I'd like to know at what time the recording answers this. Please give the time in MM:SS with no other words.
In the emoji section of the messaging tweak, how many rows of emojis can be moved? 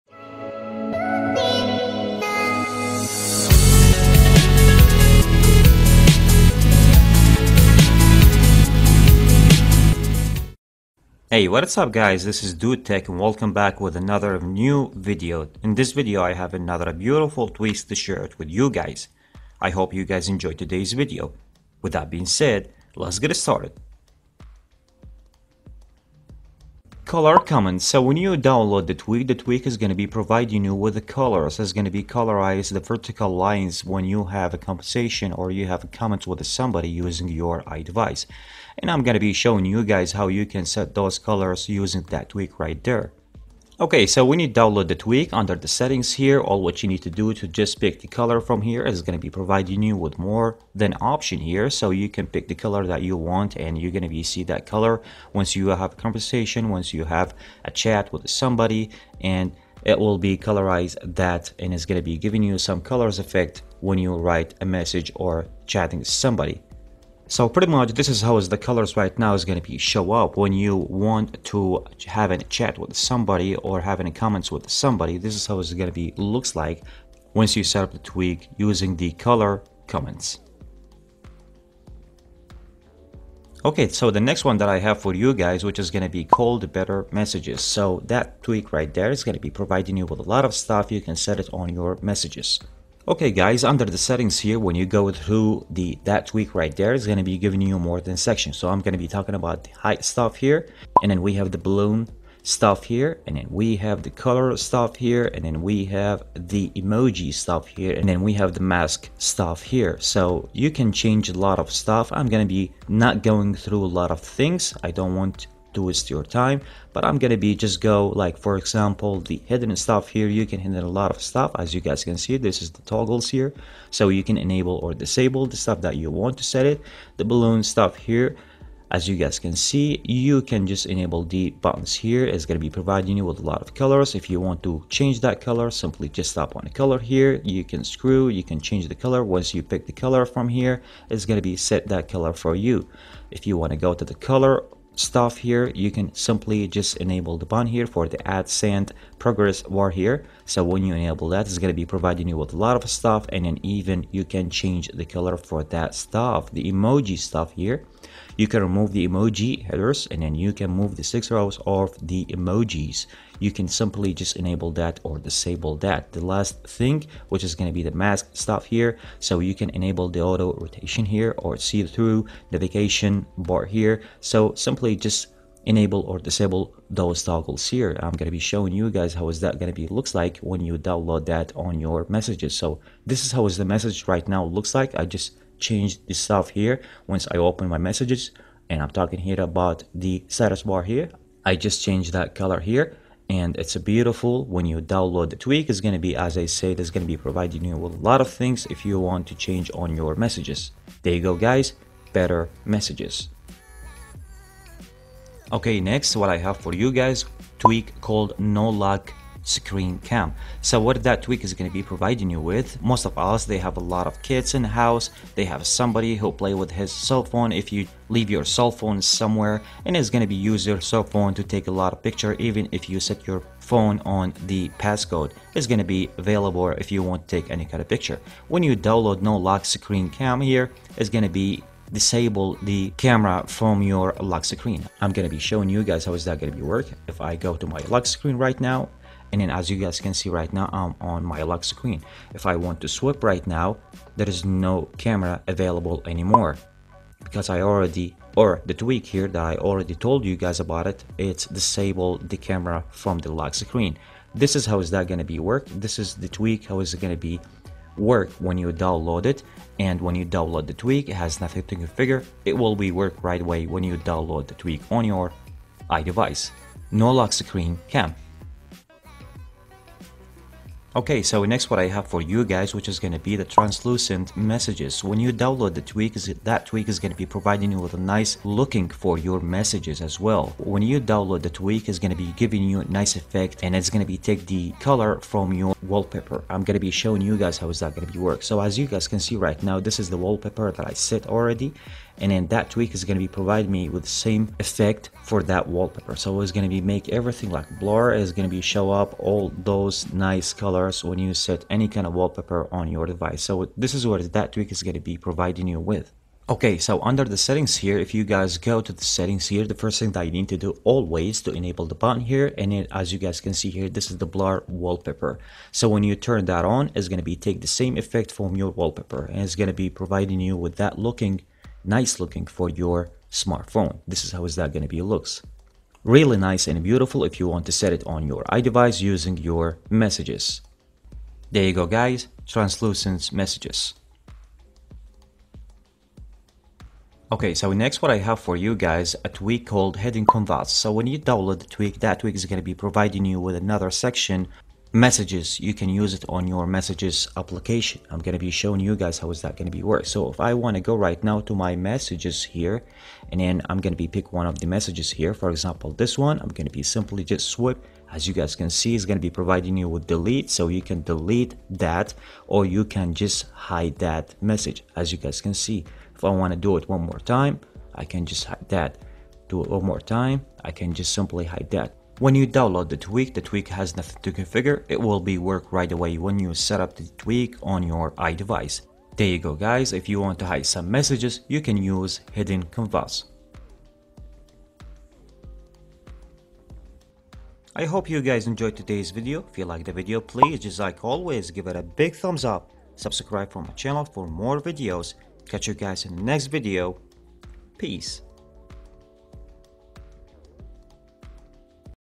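02:41.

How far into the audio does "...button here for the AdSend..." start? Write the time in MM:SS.
02:27.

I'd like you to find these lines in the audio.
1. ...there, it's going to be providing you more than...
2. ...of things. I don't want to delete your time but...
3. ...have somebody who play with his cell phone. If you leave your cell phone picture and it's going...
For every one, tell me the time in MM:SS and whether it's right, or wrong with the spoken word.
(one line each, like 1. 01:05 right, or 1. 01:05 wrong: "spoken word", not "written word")
1. 01:36 wrong: "giving", not "providing"
2. 01:54 wrong: "waste", not "delete"
3. 03:35 wrong: "somewhere", not "picture".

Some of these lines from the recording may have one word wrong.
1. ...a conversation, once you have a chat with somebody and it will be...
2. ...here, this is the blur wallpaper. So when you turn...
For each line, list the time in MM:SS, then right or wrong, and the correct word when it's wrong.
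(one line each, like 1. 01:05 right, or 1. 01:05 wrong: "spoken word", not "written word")
1. 00:55 right
2. 05:13 right.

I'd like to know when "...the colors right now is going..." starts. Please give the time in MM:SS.
01:08.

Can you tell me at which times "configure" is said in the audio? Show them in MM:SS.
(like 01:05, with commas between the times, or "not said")
04:21, 06:14.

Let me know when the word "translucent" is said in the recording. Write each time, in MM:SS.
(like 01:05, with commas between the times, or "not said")
04:33, 05:32.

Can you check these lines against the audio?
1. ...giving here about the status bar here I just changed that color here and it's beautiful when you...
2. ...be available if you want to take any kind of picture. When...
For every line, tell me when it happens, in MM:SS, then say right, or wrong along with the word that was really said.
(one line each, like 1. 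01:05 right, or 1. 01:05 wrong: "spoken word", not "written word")
1. 03:08 wrong: "talking", not "giving"
2. 03:45 right.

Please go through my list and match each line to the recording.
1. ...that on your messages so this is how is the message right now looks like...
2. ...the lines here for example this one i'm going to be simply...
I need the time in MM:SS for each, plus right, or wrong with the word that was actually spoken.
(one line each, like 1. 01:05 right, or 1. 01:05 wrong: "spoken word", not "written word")
1. 03:01 right
2. 05:54 wrong: "messages", not "lines".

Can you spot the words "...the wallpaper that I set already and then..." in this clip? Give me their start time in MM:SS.
04:50.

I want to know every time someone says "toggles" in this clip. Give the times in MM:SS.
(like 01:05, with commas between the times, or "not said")
02:02, 02:57.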